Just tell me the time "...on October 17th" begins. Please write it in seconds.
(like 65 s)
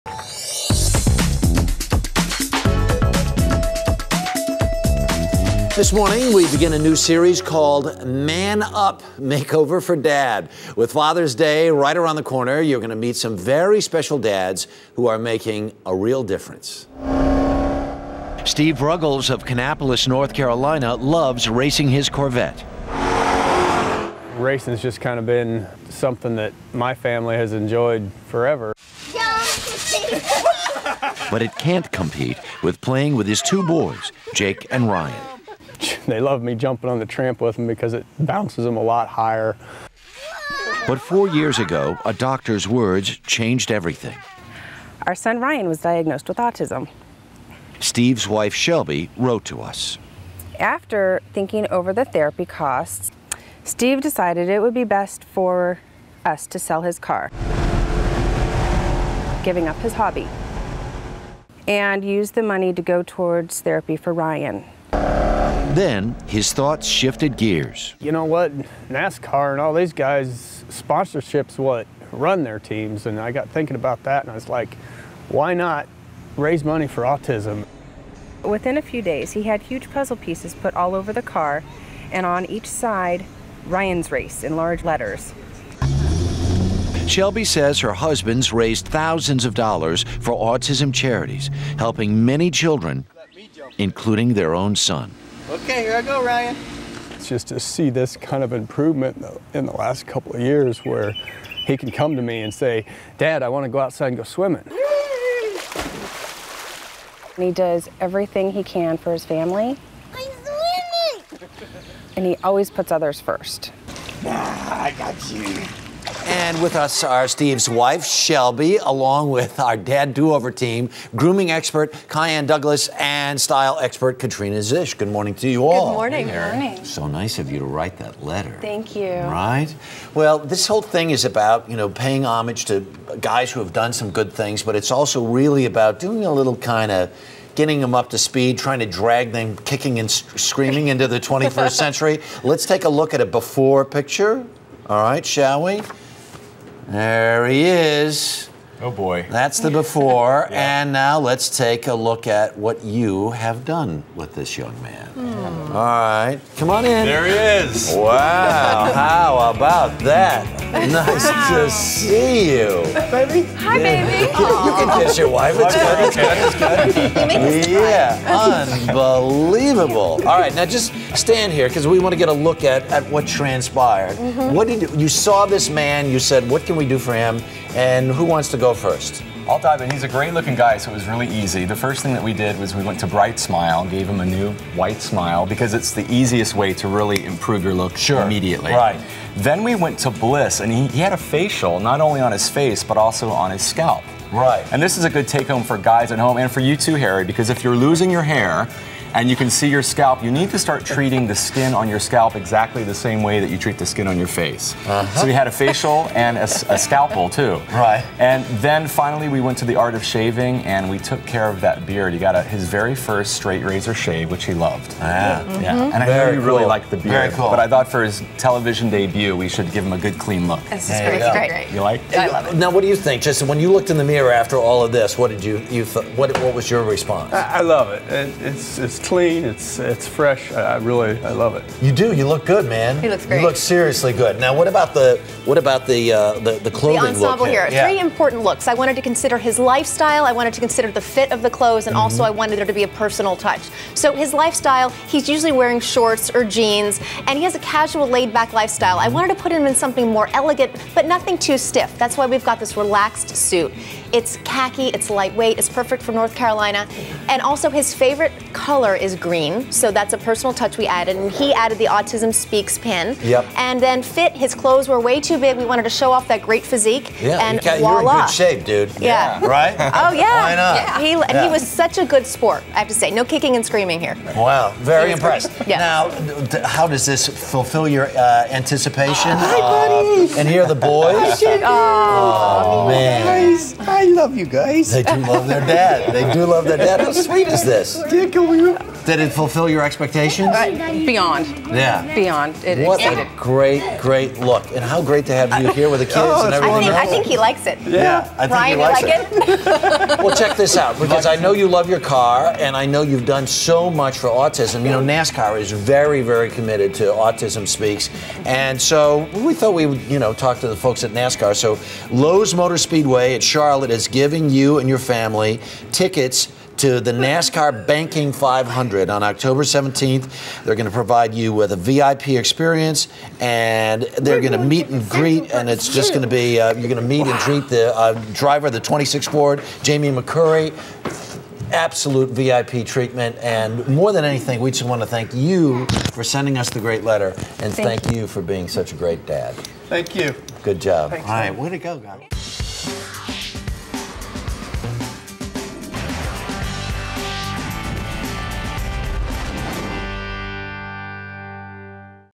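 319 s.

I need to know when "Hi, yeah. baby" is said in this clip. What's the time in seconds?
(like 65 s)
163 s.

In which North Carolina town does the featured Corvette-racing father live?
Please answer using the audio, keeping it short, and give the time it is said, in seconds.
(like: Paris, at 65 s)
Kannapolis, at 19 s.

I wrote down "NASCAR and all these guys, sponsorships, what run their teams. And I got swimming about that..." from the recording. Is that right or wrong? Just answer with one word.
wrong.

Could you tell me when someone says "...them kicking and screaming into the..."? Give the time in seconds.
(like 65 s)
139 s.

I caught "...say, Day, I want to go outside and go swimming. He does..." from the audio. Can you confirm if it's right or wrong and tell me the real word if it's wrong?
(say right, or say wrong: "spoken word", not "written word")
wrong: "Dad", not "Day".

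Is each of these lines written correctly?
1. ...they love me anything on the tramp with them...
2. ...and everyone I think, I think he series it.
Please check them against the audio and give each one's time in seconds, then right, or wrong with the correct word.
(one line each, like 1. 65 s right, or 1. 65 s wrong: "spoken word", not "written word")
1. 36 s wrong: "jumping", not "anything"
2. 296 s wrong: "likes", not "series".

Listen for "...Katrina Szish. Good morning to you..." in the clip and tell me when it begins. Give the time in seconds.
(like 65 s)
124 s.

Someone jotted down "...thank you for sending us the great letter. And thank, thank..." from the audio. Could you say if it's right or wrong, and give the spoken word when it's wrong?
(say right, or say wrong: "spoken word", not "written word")
right.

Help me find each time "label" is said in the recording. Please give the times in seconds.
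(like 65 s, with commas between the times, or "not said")
not said.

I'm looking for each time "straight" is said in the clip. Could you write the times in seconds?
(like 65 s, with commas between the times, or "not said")
213 s.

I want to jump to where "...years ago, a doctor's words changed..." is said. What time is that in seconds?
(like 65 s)
41 s.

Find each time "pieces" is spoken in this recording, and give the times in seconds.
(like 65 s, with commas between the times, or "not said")
80 s.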